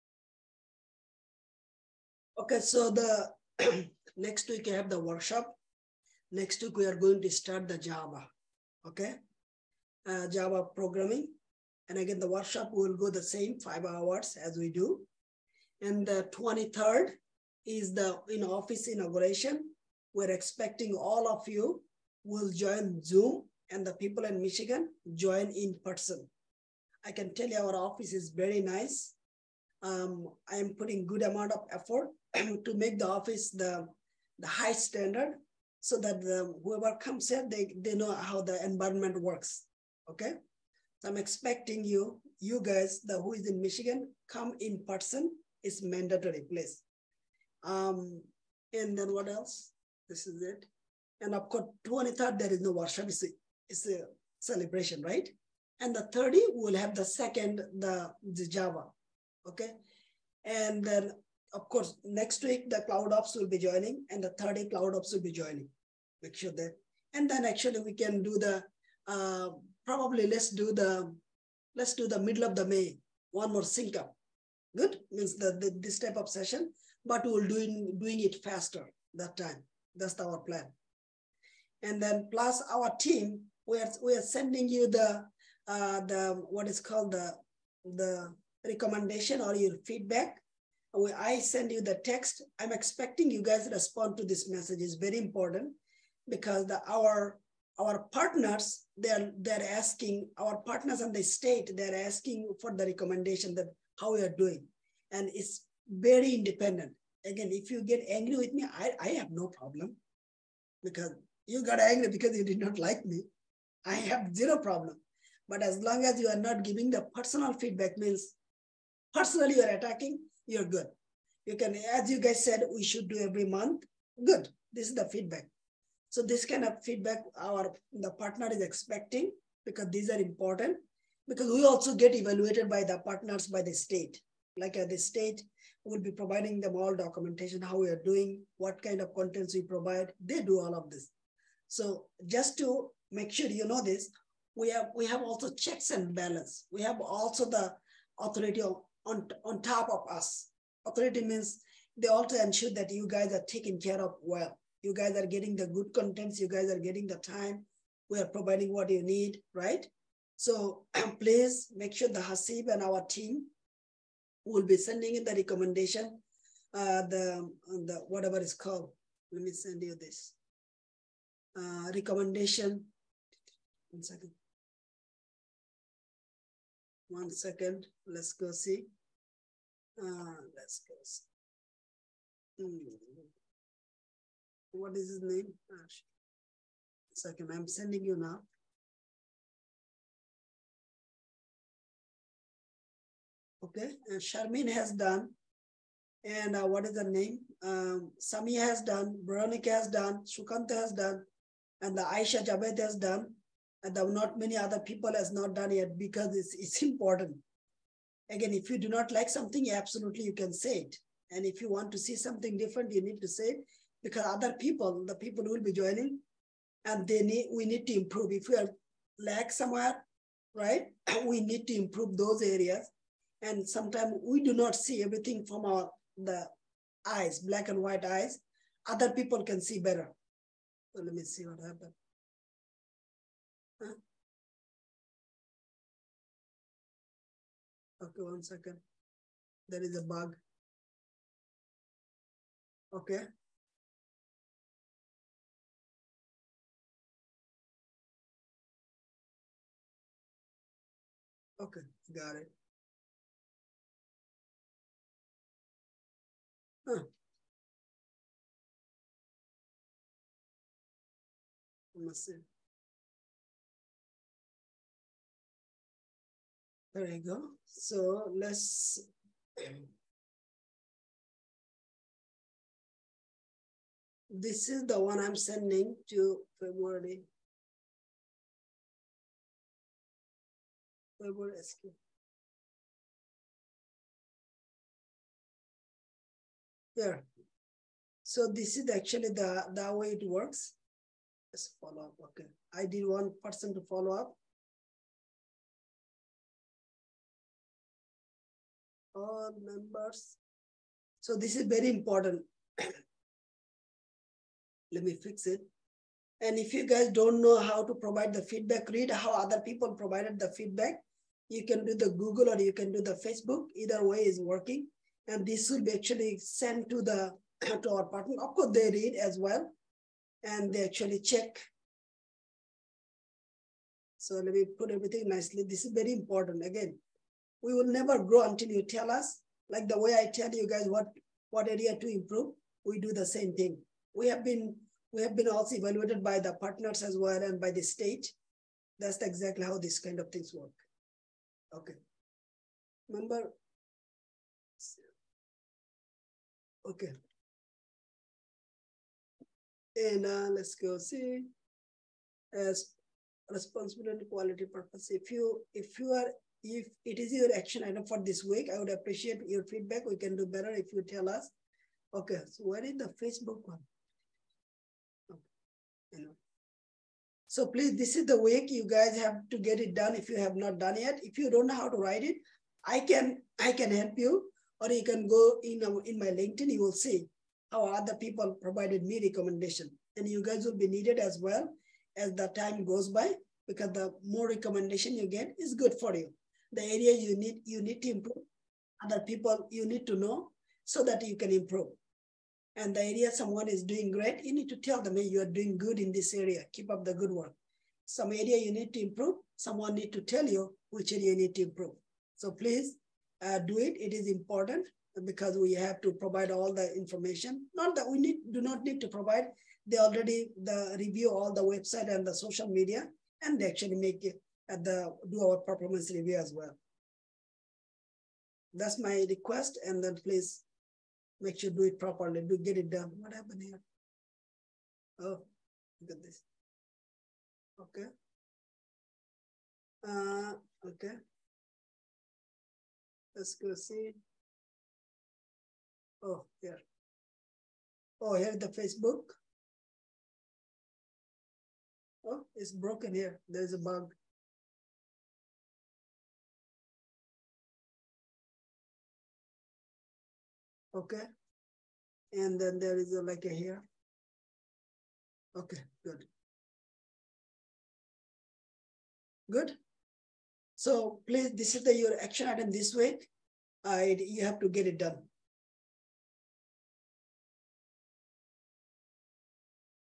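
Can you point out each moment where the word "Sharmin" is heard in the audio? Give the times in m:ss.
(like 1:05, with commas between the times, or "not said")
3:14.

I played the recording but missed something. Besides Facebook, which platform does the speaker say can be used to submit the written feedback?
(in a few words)
Google.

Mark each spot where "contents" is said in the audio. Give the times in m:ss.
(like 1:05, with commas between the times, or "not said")
2:19, 2:35.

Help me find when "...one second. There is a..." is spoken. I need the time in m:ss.
3:58.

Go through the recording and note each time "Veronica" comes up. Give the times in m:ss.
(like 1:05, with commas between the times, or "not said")
3:19.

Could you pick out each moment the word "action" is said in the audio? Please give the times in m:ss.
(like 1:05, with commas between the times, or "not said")
5:57, 7:42.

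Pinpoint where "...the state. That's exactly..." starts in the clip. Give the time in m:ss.
5:37.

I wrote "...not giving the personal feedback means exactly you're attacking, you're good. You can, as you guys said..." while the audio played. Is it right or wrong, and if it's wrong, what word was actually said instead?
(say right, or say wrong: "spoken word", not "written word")
wrong: "personally", not "exactly".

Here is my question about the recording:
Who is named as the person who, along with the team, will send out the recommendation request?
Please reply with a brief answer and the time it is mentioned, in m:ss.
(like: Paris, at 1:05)
Hasib, at 2:42.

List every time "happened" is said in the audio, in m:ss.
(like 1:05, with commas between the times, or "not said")
3:51, 7:03.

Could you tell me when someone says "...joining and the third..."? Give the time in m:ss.
1:03.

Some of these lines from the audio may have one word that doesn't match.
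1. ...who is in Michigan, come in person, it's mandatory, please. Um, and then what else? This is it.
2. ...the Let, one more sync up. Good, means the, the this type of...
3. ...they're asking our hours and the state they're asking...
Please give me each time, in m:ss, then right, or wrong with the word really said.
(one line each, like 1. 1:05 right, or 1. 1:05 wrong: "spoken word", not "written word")
1. 0:43 right
2. 1:12 wrong: "May", not "Let"
3. 1:39 wrong: "partners", not "hours".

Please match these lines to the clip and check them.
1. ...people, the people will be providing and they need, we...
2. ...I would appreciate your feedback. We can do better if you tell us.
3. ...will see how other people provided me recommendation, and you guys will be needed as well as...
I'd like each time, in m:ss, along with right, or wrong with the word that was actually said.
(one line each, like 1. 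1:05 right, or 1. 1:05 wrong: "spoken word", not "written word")
1. 3:34 wrong: "joining", not "providing"
2. 5:58 right
3. 6:16 right.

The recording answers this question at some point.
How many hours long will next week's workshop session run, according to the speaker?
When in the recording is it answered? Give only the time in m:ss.
0:13.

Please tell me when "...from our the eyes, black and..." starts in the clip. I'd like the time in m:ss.
3:45.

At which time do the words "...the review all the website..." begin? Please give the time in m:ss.
6:50.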